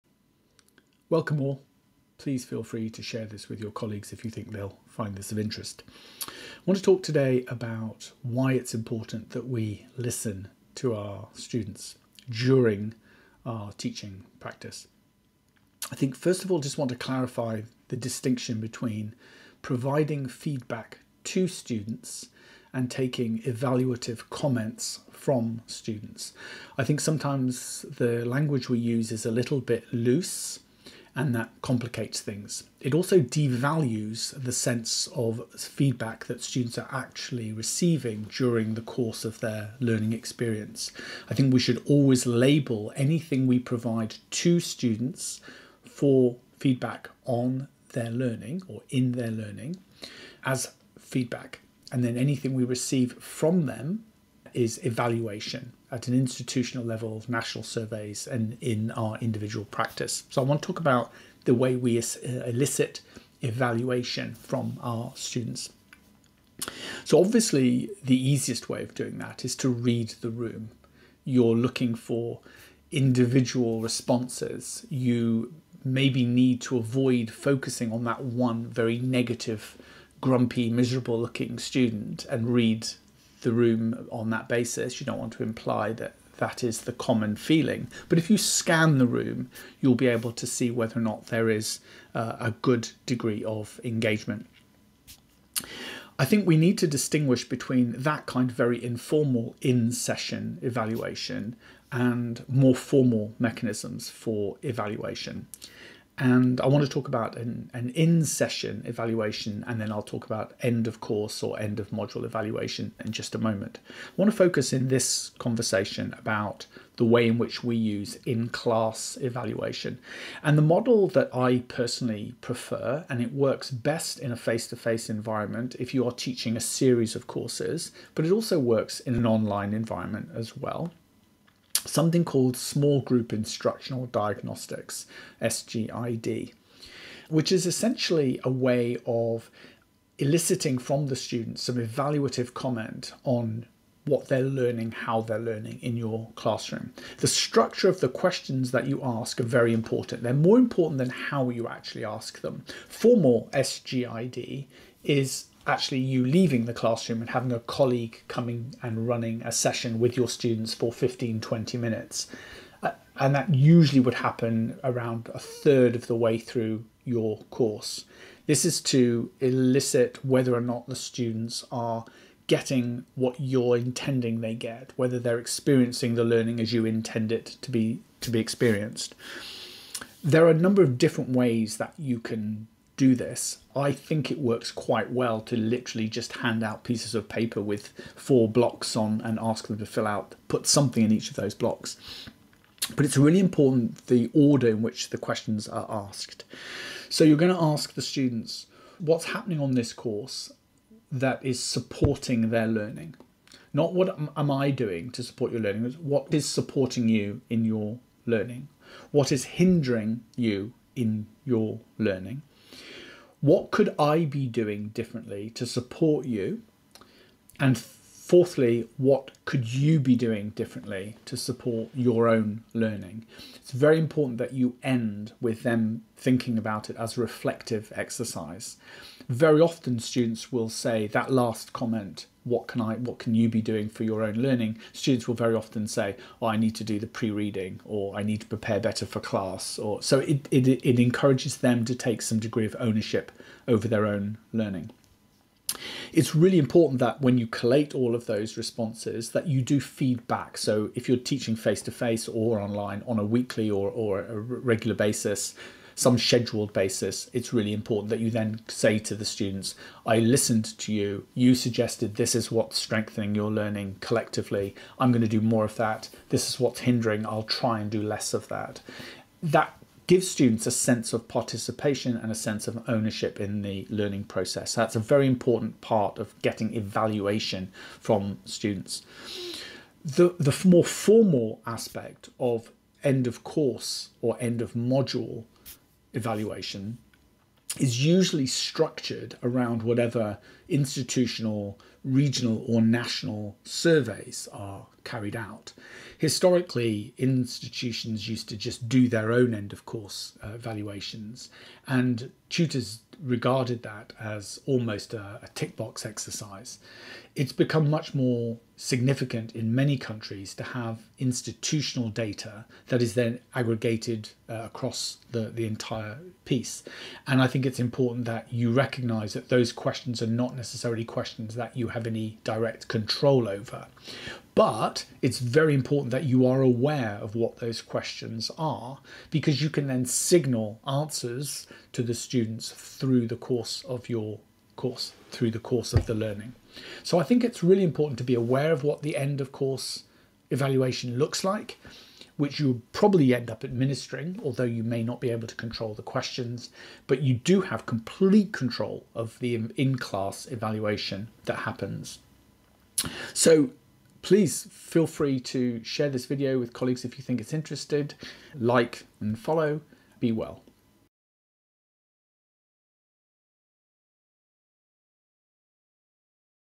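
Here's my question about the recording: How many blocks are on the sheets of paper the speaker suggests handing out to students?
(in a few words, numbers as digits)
4.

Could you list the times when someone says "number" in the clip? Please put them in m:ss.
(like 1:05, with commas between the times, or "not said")
3:00.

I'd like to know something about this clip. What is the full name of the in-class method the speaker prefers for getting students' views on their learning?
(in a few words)
Small Group Instructional Diagnostics.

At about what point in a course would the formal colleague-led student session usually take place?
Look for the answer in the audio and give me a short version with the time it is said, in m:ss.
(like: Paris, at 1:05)
a third of the way through, at 2:45.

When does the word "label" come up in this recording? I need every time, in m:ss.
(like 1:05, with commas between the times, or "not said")
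0:42.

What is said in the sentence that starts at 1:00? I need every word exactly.
So I want to talk about the way we uh, elicit evaluation from our students.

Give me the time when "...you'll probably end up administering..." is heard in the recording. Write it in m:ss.
5:42.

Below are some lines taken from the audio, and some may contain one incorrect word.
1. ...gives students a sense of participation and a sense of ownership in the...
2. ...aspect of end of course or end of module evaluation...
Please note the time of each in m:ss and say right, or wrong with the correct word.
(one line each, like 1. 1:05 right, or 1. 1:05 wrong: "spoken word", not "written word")
1. 4:30 right
2. 4:41 right.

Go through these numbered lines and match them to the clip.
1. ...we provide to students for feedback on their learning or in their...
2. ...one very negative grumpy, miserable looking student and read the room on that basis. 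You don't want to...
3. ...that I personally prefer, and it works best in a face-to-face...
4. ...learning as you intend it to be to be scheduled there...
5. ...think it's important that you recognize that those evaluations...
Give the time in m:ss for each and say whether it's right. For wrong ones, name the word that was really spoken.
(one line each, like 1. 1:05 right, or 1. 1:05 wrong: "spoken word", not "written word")
1. 0:43 right
2. 1:18 right
3. 2:01 right
4. 2:56 wrong: "experienced", not "scheduled"
5. 5:17 wrong: "questions", not "evaluations".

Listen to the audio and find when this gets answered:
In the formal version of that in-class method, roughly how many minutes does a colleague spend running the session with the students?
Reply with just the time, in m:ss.
2:40.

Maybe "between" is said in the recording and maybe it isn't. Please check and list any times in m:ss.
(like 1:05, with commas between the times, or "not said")
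0:18, 1:37.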